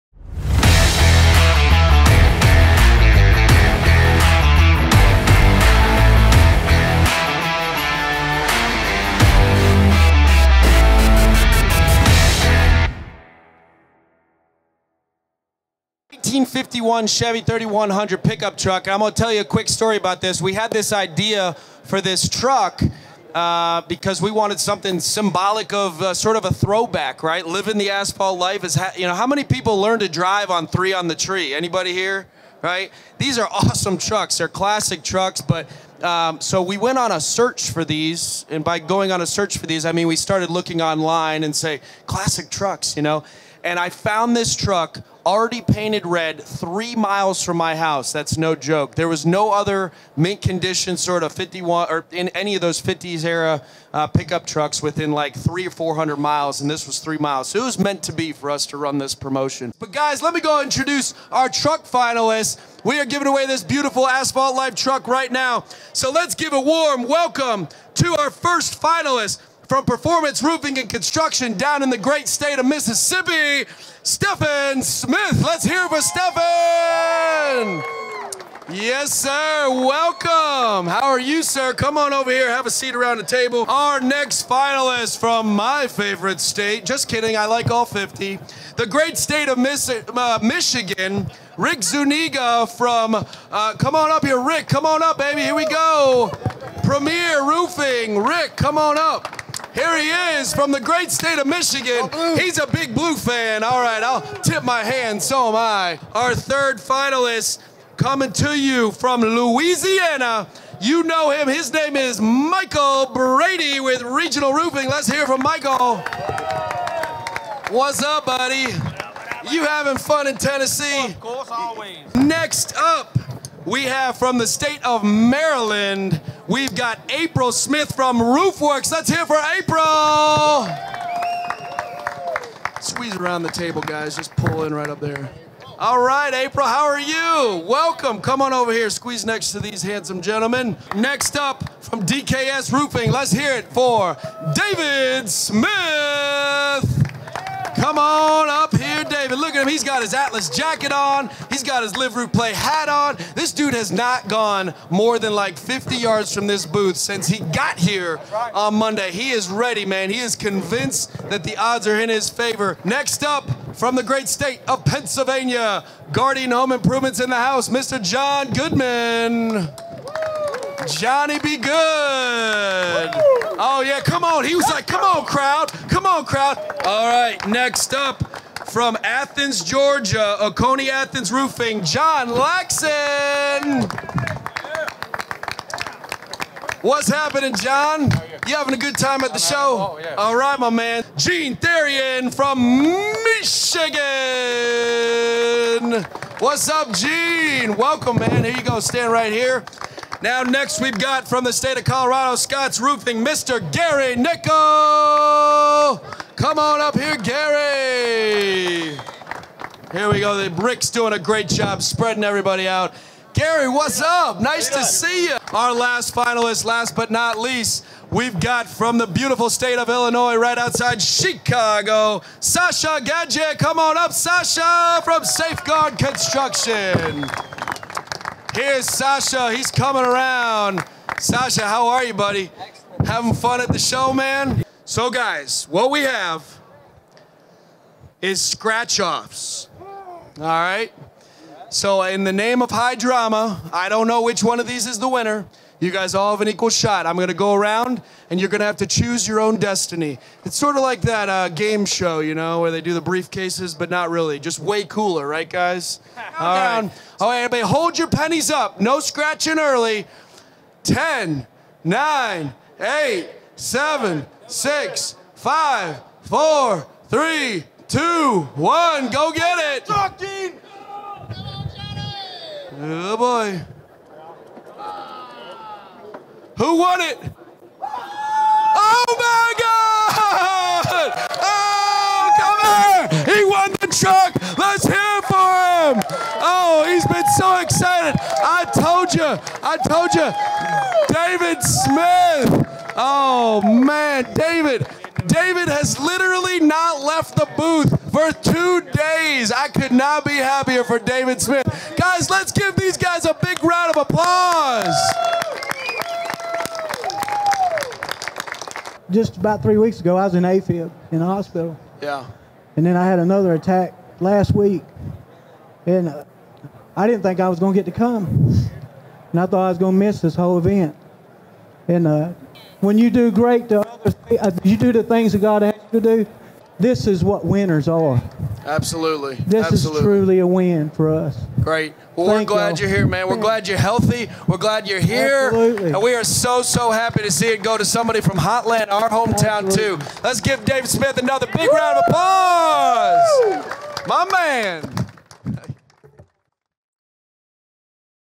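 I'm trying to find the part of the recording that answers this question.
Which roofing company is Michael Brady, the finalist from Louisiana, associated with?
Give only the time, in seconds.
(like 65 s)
114 s.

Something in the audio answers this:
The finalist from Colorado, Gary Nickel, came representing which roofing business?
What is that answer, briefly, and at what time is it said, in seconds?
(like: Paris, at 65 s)
Scott's Roofing, at 202 s.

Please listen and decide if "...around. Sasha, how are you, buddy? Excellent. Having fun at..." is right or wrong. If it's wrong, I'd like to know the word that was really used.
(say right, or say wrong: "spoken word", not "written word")
right.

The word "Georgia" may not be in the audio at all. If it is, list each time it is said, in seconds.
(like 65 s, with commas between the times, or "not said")
179 s.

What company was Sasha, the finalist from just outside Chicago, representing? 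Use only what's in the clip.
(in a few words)
Safeguard Construction.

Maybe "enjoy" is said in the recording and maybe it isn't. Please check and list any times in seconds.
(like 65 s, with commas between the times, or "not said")
not said.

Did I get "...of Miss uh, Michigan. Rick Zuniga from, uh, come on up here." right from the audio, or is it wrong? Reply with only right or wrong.
right.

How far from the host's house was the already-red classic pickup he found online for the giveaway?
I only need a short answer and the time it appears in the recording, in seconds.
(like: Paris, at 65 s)
3 miles, at 46 s.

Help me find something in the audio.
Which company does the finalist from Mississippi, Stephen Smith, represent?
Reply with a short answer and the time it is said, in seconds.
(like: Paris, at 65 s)
Performance Roofing and Construction, at 69 s.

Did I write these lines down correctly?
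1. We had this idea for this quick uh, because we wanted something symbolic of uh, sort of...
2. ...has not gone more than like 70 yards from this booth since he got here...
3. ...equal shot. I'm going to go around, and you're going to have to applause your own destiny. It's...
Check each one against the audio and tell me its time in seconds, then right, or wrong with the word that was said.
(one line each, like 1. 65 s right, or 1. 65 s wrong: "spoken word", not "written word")
1. 20 s wrong: "truck", not "quick"
2. 153 s wrong: "50", not "70"
3. 246 s wrong: "choose", not "applause".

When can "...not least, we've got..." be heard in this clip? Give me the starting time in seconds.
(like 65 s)
217 s.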